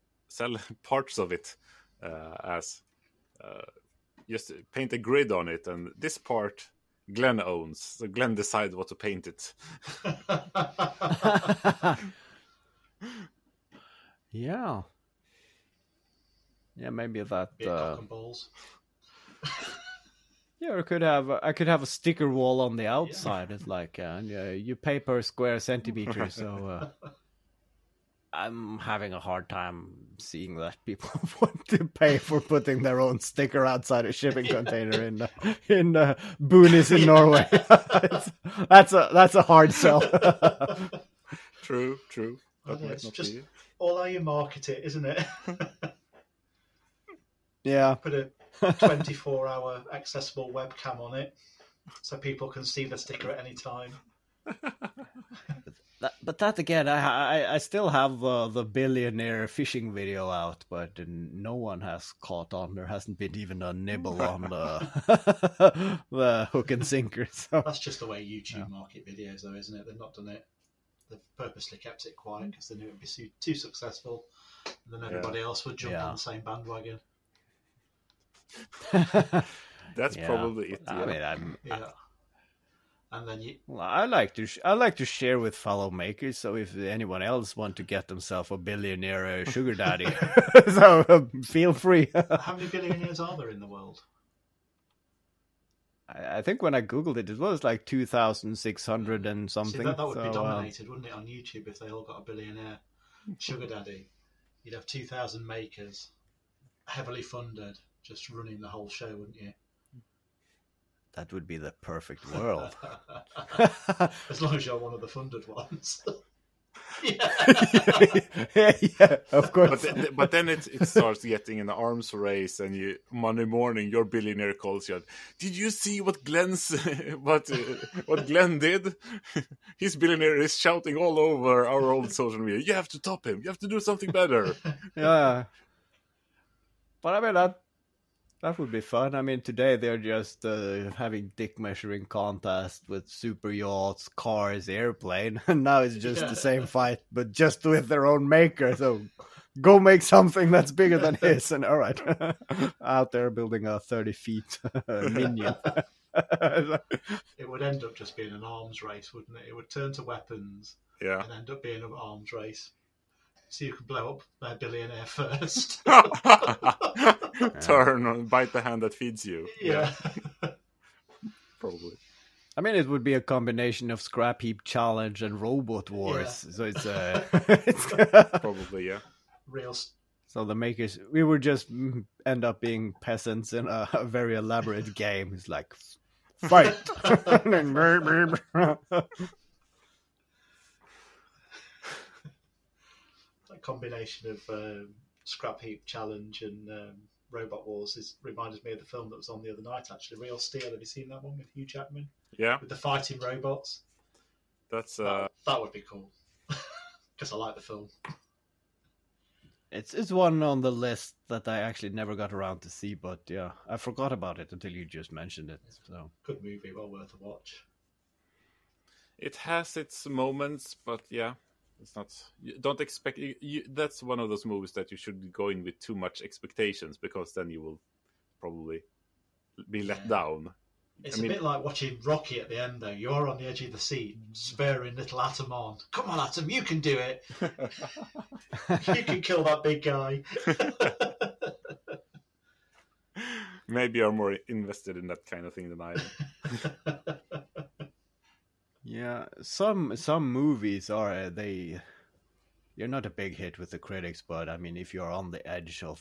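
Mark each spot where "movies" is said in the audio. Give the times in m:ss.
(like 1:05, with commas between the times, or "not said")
3:36, 3:44, 4:10.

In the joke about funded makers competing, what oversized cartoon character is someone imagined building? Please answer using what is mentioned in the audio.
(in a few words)
Minion.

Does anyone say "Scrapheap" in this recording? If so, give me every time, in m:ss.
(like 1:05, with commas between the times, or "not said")
2:54, 3:15.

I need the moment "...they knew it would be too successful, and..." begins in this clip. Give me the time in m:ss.
1:12.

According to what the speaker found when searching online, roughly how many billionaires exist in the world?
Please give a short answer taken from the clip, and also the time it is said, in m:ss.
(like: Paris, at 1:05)
2,600, at 1:37.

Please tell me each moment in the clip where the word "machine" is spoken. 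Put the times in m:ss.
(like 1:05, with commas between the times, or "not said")
not said.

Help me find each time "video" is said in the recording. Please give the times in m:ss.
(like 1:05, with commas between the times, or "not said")
0:59, 1:09.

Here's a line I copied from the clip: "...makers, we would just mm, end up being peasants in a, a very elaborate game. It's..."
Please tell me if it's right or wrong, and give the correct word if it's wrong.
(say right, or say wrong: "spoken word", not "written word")
right.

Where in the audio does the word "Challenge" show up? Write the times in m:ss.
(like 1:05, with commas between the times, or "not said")
2:54, 3:15.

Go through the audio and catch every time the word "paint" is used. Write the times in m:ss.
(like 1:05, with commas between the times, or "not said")
0:04, 0:08.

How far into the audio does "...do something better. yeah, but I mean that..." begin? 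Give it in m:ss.
2:13.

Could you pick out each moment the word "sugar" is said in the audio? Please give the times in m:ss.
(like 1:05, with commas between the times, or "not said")
1:29, 1:43.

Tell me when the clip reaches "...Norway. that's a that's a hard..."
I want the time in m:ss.
0:37.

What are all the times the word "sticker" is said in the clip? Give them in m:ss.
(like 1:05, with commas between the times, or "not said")
0:21, 0:33, 0:52.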